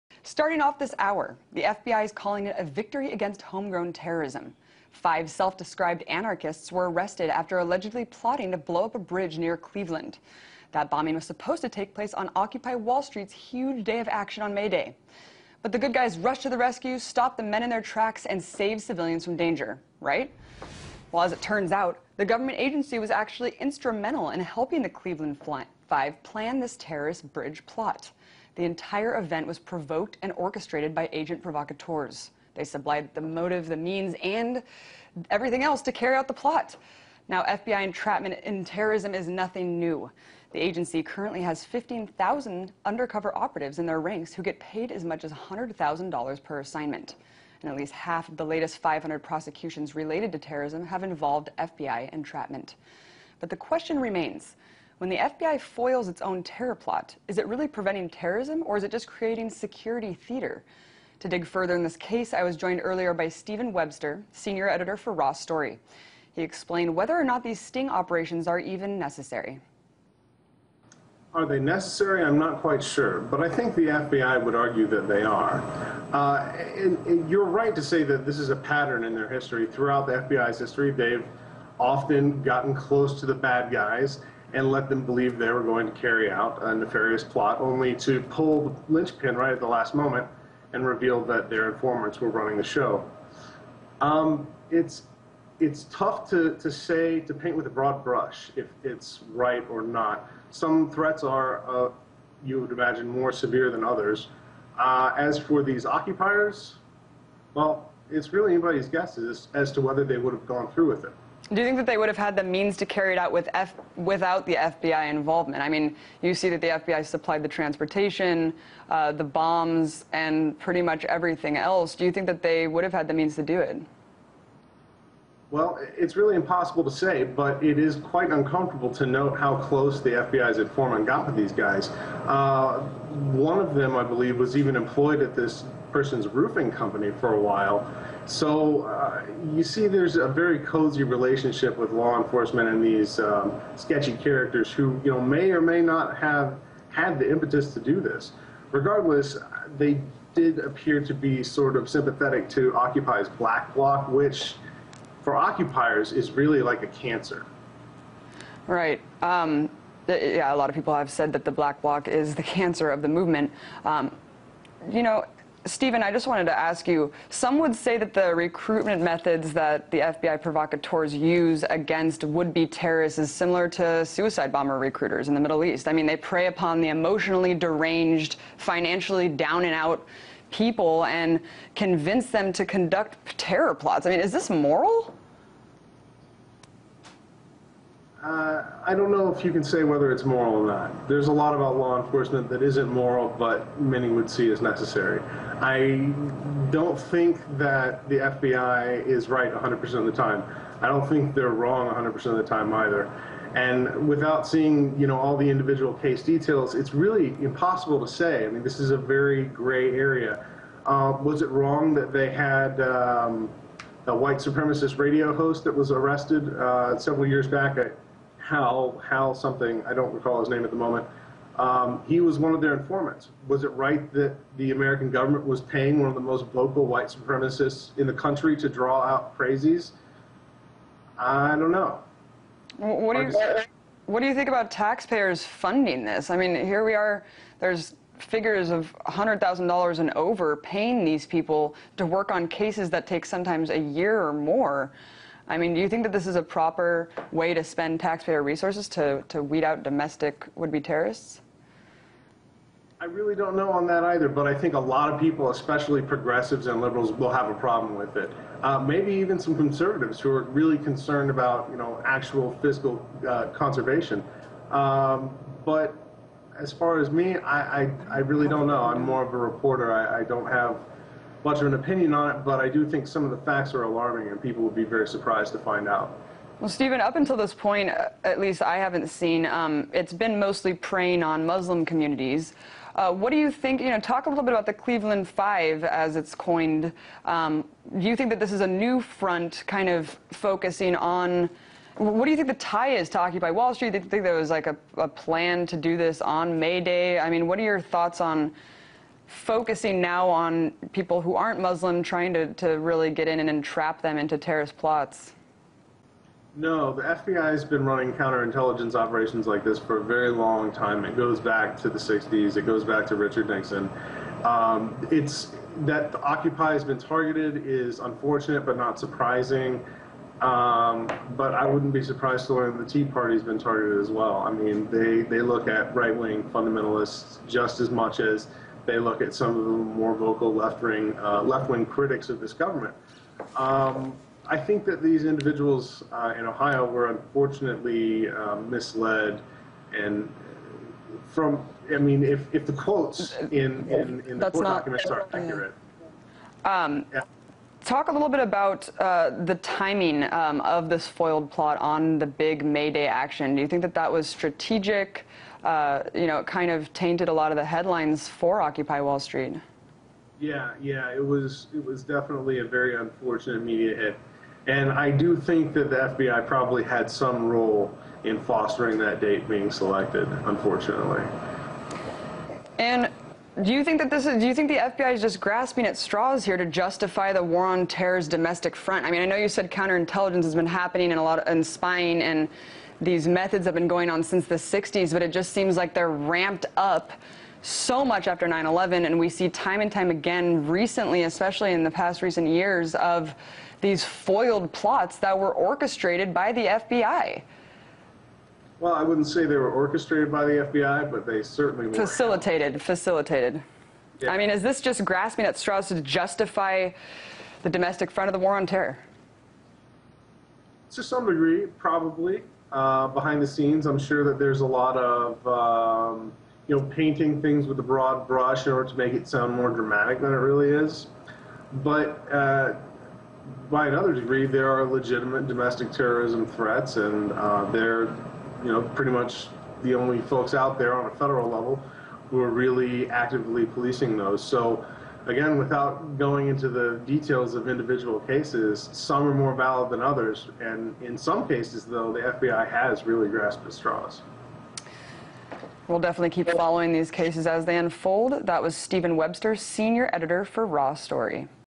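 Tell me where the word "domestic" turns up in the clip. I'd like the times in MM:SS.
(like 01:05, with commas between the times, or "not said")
04:09, 06:18, 06:47, 07:05.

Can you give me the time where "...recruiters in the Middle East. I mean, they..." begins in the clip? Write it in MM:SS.
02:54.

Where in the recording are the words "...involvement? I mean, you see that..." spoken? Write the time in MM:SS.
01:55.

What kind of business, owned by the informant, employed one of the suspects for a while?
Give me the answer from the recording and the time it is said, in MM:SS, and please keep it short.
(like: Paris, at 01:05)
roofing company, at 02:16.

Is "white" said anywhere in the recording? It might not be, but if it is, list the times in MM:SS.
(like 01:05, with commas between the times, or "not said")
03:34, 03:46.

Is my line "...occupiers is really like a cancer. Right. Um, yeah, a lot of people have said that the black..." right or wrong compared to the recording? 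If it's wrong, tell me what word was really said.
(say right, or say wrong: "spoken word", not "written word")
right.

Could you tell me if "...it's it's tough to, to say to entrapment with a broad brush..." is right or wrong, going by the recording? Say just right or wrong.
wrong.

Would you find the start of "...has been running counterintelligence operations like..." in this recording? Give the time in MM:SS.
05:07.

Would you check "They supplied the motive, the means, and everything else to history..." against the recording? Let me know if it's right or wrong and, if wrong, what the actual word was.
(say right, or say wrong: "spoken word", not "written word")
wrong: "carry", not "history".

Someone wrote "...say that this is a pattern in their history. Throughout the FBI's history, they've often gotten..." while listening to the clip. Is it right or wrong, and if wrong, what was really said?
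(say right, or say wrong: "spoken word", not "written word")
right.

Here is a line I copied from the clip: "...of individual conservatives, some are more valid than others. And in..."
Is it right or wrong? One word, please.
wrong.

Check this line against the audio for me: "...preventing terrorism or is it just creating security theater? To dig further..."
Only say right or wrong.
right.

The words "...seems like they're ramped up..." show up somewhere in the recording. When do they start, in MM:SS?
06:25.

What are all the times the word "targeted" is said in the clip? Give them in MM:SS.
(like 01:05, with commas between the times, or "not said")
05:16, 05:23.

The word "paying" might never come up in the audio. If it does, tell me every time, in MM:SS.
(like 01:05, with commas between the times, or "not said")
03:45, 04:00.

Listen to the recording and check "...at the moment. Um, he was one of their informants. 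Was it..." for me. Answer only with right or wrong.
right.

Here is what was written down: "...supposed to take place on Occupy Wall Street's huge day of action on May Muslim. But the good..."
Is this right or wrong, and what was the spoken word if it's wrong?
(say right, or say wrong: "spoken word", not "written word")
wrong: "Day", not "Muslim".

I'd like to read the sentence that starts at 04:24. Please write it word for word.
Um, but as far as me, I, I, I, really don't know.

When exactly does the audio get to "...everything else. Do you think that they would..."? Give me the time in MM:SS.
02:01.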